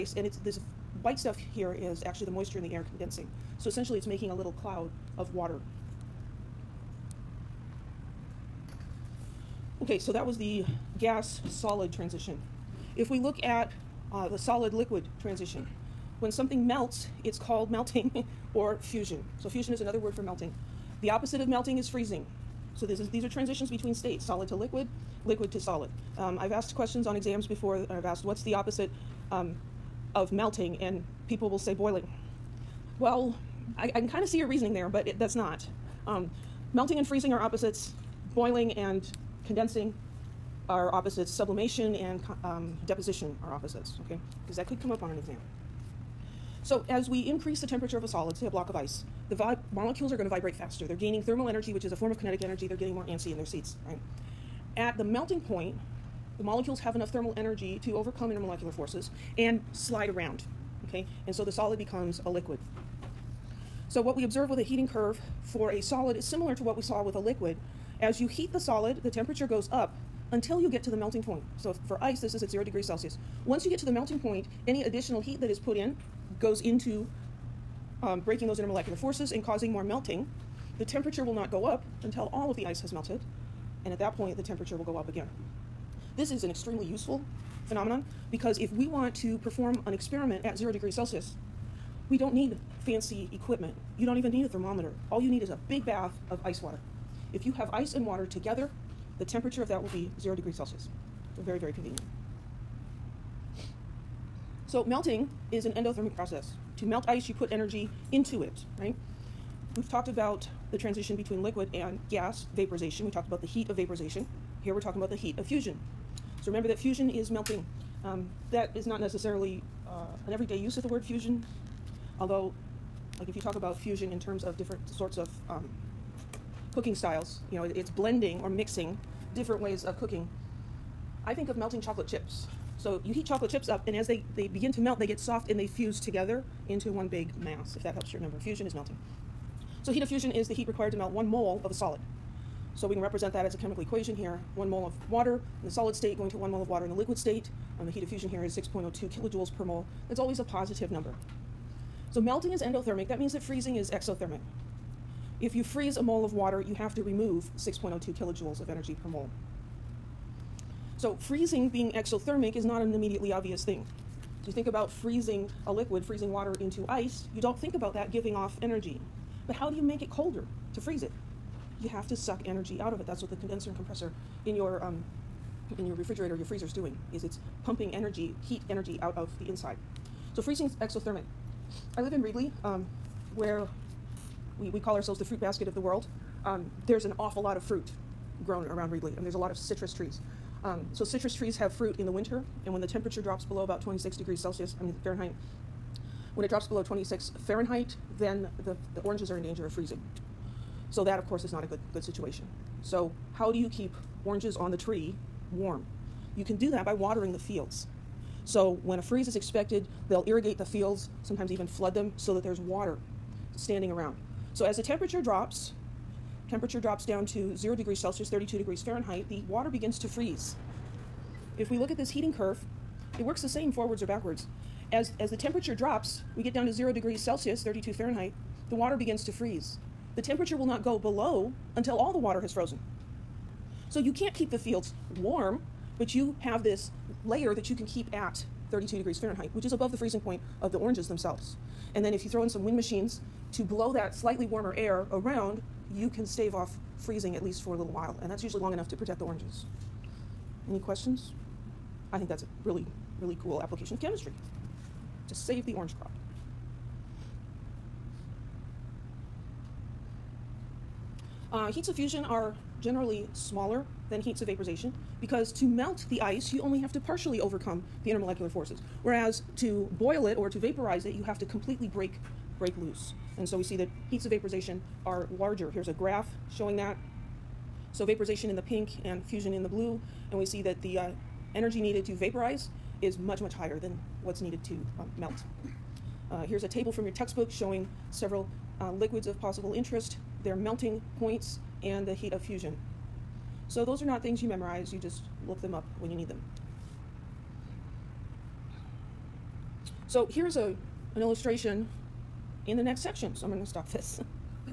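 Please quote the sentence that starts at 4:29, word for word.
Whereas to boil it or to vaporize it, you have to completely break, break loose.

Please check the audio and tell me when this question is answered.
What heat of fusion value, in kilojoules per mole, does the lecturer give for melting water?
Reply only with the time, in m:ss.
2:28.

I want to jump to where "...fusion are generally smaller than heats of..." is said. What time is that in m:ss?
4:21.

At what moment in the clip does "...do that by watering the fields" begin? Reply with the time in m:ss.
3:26.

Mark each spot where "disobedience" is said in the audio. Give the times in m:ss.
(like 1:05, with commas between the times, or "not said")
not said.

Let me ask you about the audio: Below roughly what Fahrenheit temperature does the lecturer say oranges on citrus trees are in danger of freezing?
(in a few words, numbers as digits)
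26 degrees Fahrenheit.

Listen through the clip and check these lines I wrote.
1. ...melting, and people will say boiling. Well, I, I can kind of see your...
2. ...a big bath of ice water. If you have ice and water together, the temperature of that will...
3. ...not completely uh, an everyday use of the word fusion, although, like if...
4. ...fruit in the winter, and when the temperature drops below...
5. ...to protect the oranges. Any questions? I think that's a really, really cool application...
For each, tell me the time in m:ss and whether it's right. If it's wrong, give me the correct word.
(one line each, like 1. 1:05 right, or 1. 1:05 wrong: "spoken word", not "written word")
1. 0:30 right
2. 1:35 right
3. 1:58 wrong: "necessarily", not "completely"
4. 3:11 right
5. 4:08 right.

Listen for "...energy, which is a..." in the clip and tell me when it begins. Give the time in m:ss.
0:51.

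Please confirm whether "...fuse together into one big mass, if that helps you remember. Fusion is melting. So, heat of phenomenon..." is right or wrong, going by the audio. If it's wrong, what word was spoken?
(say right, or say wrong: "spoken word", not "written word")
wrong: "fusion", not "phenomenon".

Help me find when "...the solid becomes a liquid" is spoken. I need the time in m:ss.
1:01.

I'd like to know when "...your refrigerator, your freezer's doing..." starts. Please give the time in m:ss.
2:55.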